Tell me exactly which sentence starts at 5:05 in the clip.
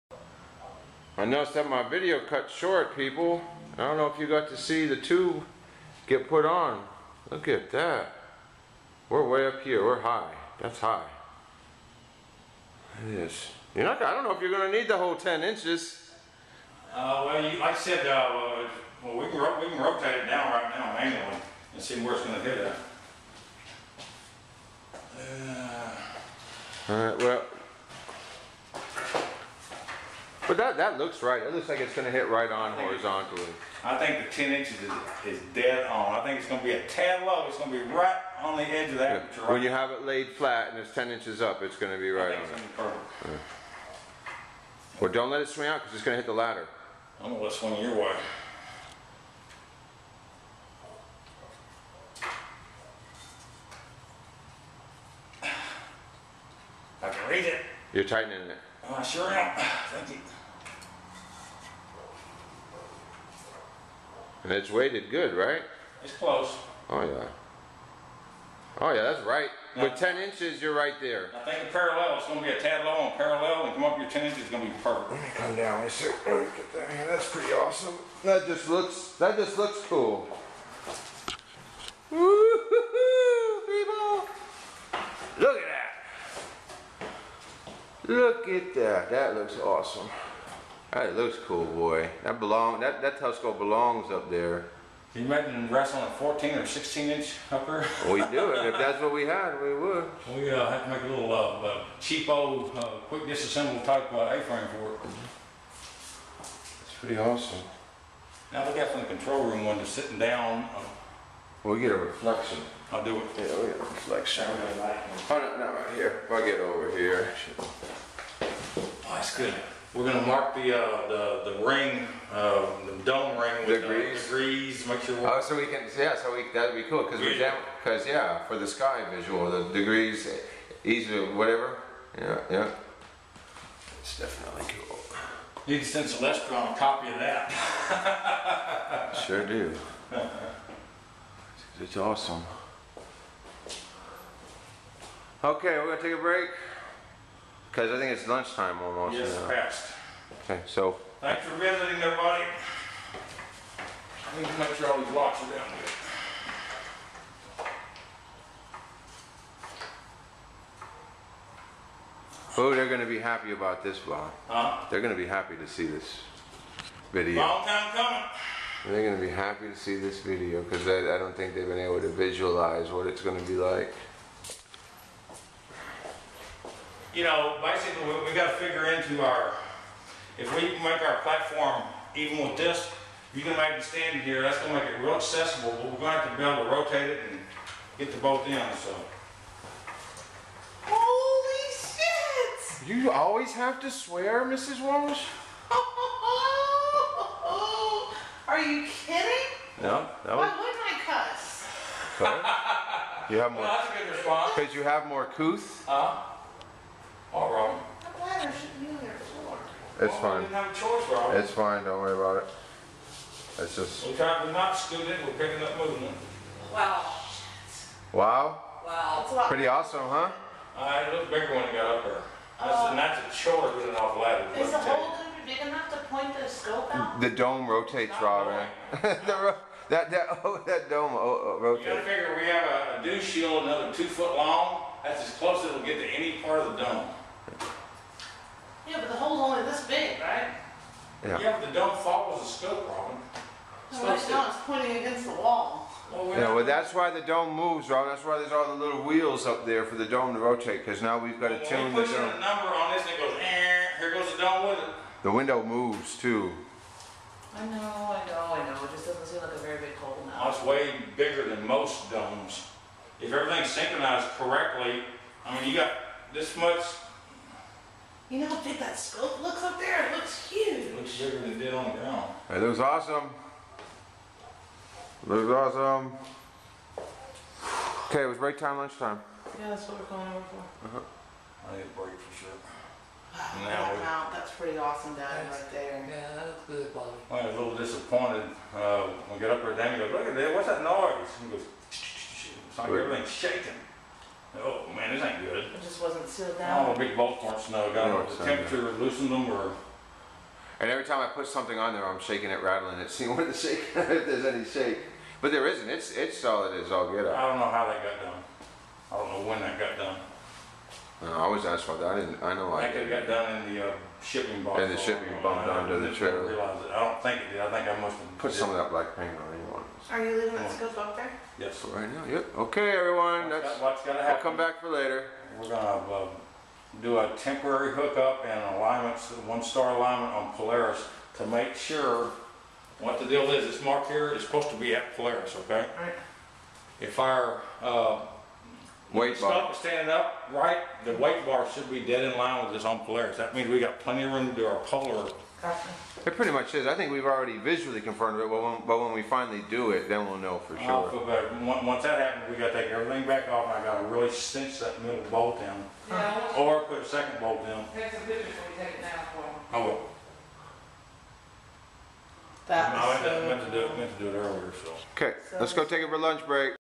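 It's it's solid as all get I don't know how that got done.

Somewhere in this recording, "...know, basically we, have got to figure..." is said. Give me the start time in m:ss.
2:57.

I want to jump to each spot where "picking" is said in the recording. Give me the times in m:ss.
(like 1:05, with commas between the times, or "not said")
3:35.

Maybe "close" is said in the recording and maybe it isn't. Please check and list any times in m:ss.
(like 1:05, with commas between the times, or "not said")
1:06, 3:55.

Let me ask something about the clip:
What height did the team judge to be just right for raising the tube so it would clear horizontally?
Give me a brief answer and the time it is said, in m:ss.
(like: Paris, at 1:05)
10 inches, at 0:34.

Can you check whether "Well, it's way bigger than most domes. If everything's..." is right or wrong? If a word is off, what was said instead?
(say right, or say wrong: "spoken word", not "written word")
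right.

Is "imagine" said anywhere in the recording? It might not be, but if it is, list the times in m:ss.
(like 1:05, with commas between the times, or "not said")
1:35.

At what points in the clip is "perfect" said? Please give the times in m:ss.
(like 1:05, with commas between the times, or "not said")
0:42, 1:14.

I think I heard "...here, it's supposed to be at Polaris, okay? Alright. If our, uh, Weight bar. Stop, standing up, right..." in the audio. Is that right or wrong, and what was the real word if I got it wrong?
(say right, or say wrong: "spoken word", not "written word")
right.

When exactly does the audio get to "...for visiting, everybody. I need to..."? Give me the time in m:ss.
2:31.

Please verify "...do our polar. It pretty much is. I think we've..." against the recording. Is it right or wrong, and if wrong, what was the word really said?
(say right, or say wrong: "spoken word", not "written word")
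right.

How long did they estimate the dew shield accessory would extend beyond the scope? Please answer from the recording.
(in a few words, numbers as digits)
2 feet.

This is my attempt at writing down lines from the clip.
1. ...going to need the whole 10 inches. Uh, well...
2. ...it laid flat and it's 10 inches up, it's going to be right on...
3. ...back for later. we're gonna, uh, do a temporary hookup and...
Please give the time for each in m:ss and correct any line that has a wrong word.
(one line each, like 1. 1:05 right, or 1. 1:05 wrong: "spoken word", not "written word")
1. 0:14 right
2. 0:39 right
3. 5:24 right.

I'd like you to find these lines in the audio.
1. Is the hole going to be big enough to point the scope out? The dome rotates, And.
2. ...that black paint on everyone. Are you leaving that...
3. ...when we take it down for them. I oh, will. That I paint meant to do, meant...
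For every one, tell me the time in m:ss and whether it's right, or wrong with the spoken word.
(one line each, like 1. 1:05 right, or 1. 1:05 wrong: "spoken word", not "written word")
1. 3:44 wrong: "Robin", not "And"
2. 5:18 wrong: "anyone", not "everyone"
3. 5:58 wrong: "meant", not "paint".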